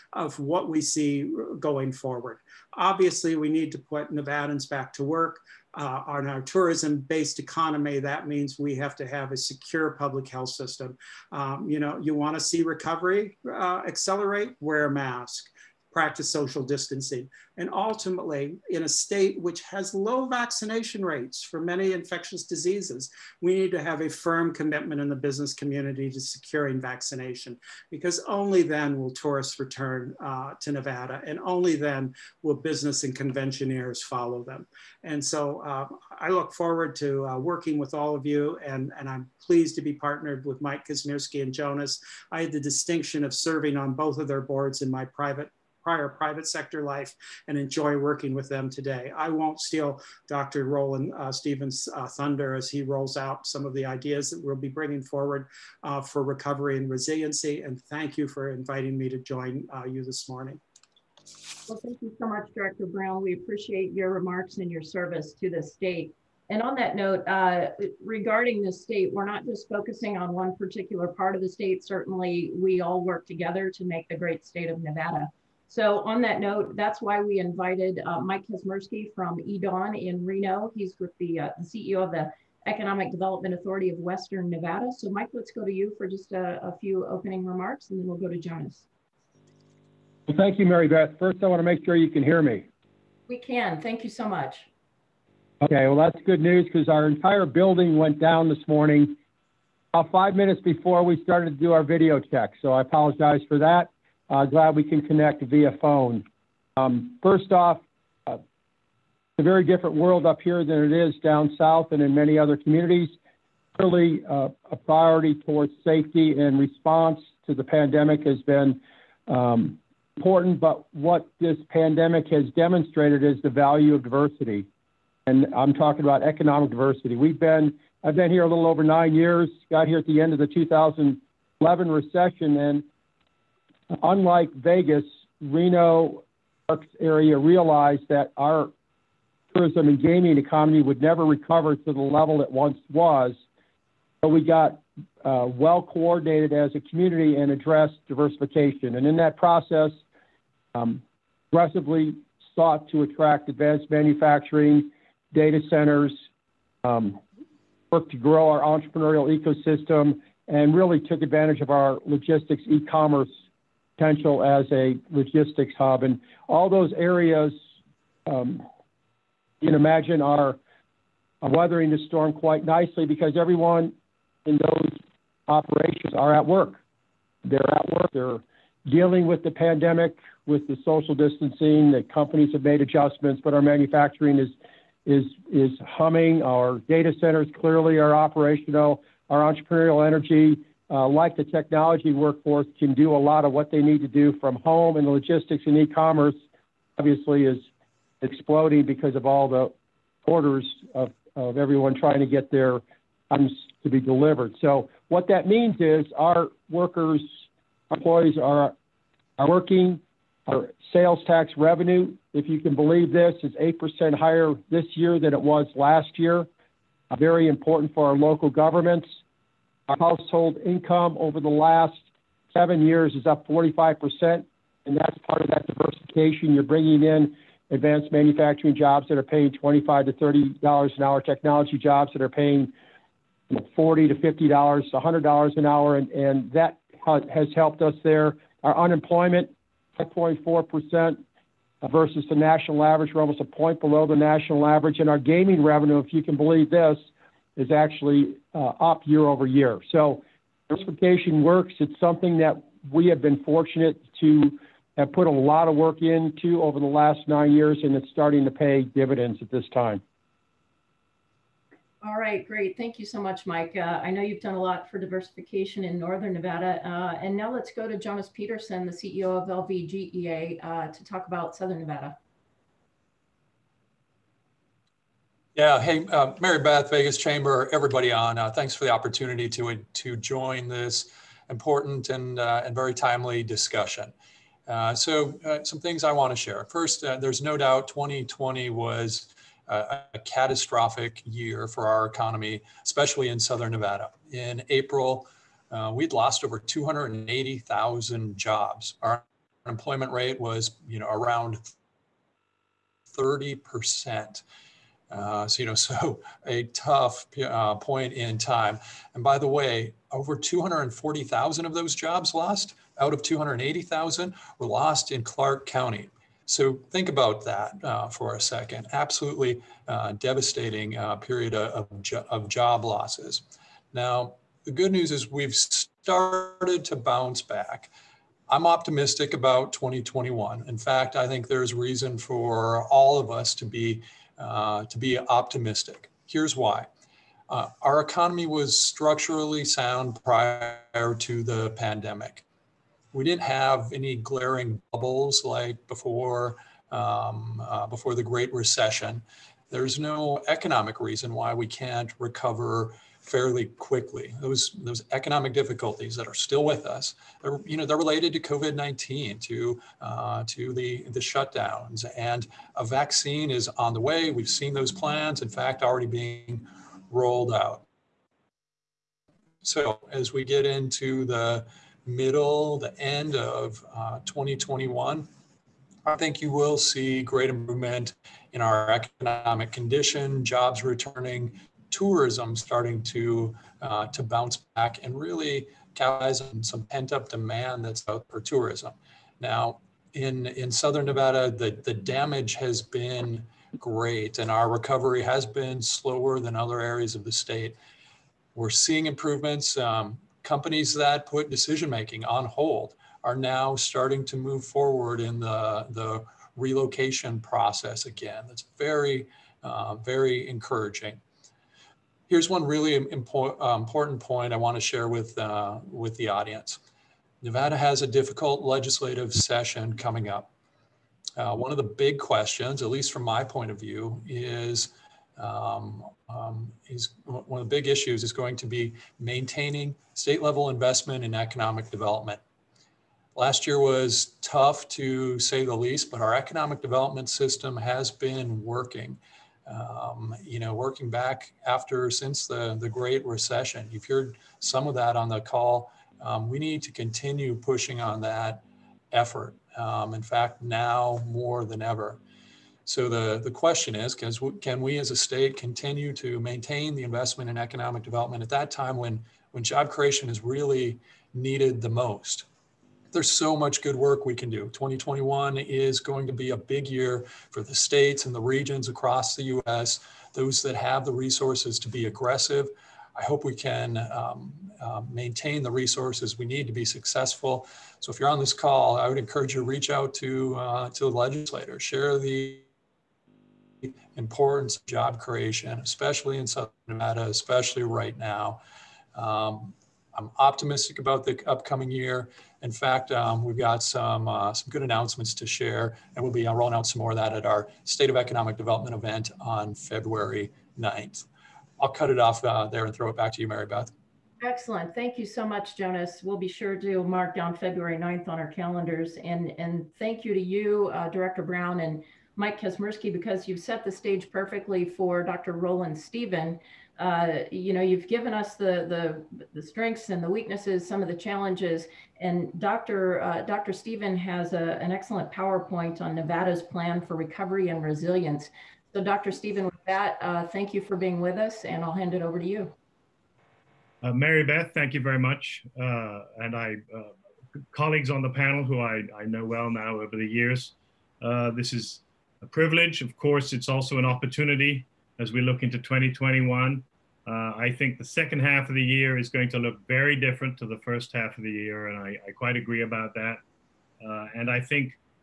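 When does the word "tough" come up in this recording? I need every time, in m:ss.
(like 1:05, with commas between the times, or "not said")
5:06, 7:14.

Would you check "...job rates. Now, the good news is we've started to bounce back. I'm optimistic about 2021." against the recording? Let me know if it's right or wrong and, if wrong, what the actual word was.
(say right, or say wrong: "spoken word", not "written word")
wrong: "losses", not "rates".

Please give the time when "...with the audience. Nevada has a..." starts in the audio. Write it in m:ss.
6:55.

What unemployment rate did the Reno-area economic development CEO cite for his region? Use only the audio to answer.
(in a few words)
5.4%.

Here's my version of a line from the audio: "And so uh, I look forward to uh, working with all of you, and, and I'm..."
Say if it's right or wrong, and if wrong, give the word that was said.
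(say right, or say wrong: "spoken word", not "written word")
right.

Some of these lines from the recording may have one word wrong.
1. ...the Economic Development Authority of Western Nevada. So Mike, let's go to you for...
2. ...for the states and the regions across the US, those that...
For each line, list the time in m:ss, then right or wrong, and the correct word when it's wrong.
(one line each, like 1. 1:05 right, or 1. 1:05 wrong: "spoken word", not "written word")
1. 1:22 right
2. 7:47 right.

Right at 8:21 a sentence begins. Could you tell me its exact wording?
I'll cut it off uh, there and throw it back to you, Mary Beth.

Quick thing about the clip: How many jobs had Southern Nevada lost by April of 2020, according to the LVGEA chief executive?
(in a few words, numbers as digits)
over 280,000.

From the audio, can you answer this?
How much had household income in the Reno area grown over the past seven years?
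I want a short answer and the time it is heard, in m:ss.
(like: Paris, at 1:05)
45%, at 3:43.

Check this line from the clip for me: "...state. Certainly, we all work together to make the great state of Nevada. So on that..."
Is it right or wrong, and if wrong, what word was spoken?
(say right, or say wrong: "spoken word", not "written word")
right.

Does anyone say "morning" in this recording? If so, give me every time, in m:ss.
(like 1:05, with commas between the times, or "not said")
1:00, 1:38.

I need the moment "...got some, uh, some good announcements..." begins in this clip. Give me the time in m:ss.
8:13.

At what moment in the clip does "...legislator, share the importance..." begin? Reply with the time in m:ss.
8:01.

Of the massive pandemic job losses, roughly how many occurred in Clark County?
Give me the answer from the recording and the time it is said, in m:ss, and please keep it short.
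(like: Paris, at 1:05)
over 240,000, at 5:10.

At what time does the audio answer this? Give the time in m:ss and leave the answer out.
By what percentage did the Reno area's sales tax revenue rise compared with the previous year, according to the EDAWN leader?
3:33.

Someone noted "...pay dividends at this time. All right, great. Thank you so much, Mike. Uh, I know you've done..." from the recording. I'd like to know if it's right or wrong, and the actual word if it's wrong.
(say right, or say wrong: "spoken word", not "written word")
right.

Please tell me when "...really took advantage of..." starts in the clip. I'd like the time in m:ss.
2:40.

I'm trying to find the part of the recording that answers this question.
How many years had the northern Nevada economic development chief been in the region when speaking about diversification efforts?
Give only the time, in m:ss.
2:08.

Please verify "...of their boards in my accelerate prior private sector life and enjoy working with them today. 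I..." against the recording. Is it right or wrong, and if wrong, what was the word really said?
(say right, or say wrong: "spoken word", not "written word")
wrong: "private", not "accelerate".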